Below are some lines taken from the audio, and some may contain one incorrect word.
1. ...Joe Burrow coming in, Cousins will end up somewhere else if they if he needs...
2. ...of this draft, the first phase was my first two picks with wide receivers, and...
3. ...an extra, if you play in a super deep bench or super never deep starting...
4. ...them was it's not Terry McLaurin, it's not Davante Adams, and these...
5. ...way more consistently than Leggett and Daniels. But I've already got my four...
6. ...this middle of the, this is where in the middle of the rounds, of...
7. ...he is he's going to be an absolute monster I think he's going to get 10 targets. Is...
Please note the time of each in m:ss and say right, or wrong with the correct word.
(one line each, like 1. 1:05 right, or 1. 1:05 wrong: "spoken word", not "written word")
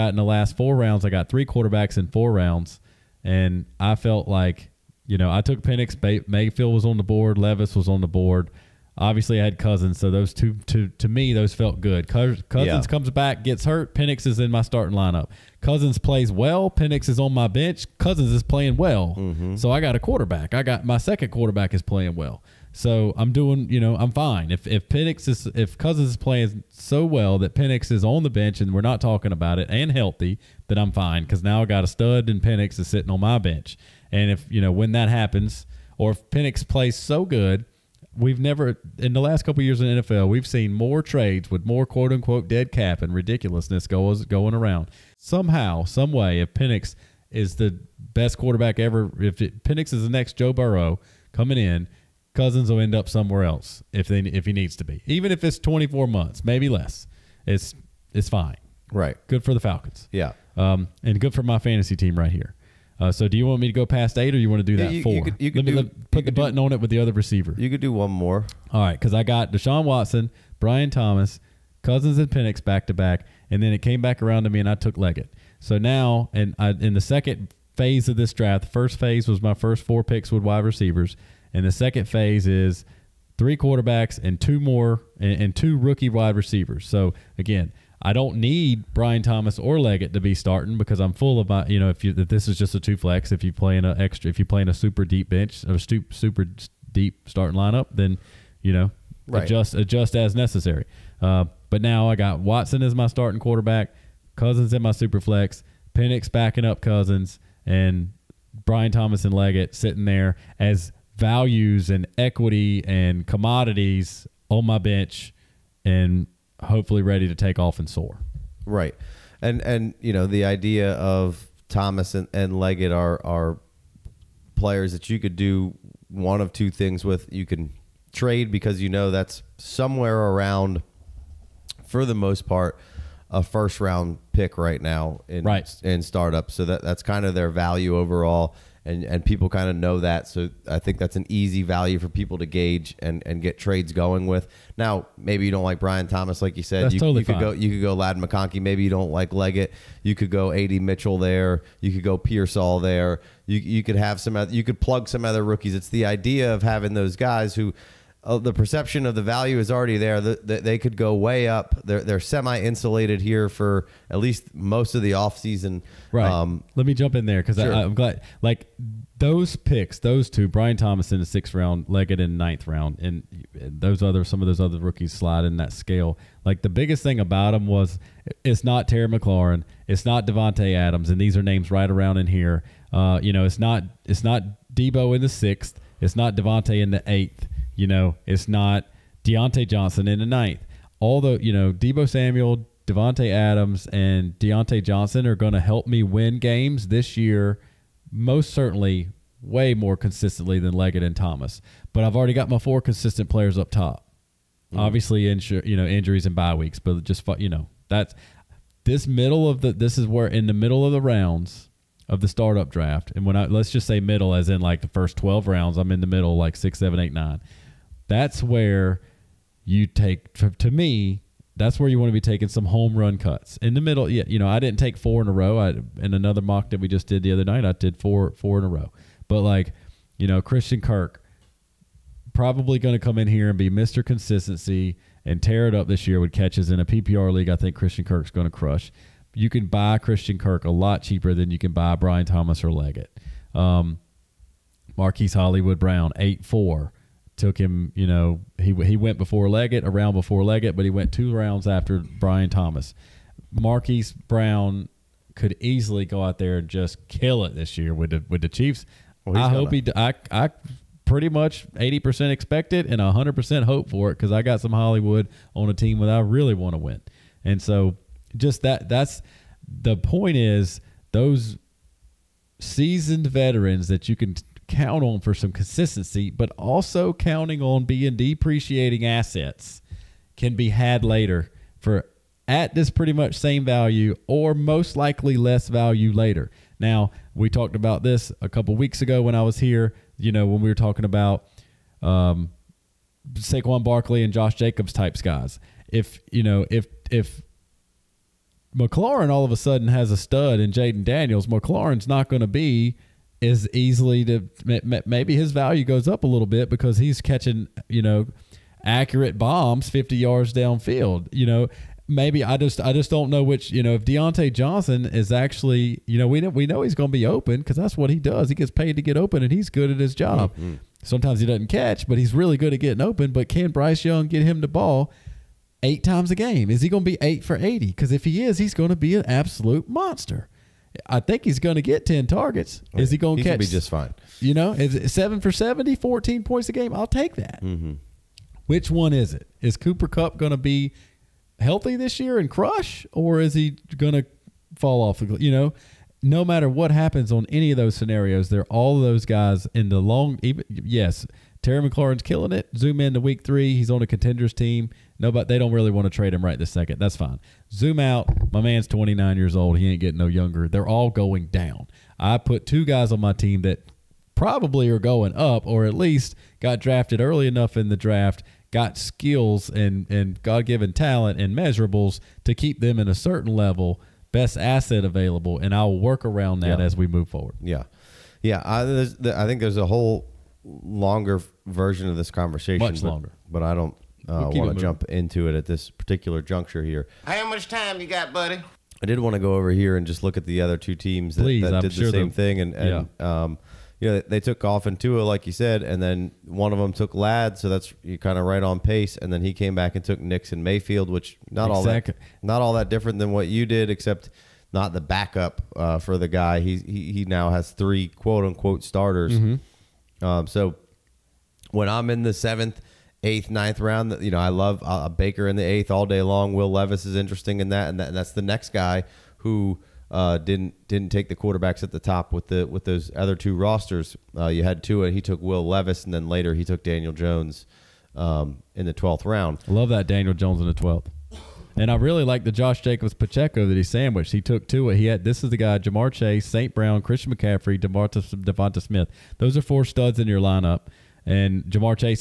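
1. 0:50 right
2. 1:18 wrong: "four", not "two"
3. 1:33 wrong: "super", not "never"
4. 2:57 right
5. 3:19 wrong: "Thomas", not "Daniels"
6. 3:28 right
7. 5:28 right.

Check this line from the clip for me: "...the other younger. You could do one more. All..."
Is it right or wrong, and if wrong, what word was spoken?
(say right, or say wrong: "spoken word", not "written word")
wrong: "receiver", not "younger".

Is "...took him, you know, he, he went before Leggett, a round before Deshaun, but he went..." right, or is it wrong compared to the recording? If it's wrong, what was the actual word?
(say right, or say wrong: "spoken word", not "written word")
wrong: "Leggett", not "Deshaun".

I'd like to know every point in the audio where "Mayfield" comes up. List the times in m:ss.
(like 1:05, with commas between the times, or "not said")
0:06, 6:40.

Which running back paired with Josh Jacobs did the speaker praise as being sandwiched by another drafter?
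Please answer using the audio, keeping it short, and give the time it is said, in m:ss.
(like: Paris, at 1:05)
Pacheco, at 7:13.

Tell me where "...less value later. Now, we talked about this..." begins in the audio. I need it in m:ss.
4:45.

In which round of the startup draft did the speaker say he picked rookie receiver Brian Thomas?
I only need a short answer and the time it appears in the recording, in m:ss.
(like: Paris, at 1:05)
6th, at 2:51.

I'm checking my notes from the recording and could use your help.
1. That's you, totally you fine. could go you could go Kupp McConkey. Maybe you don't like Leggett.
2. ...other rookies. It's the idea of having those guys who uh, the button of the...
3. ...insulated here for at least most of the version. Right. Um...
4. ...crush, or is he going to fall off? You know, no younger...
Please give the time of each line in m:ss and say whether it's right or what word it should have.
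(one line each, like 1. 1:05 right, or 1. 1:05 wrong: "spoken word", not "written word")
1. 2:26 wrong: "Ladd", not "Kupp"
2. 2:35 wrong: "perception", not "button"
3. 2:42 wrong: "offseason", not "version"
4. 5:42 wrong: "matter", not "younger".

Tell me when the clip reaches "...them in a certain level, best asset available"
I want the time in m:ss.
6:12.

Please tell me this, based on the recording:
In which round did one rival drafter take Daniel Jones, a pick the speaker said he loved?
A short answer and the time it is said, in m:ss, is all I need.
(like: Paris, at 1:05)
12th, at 7:08.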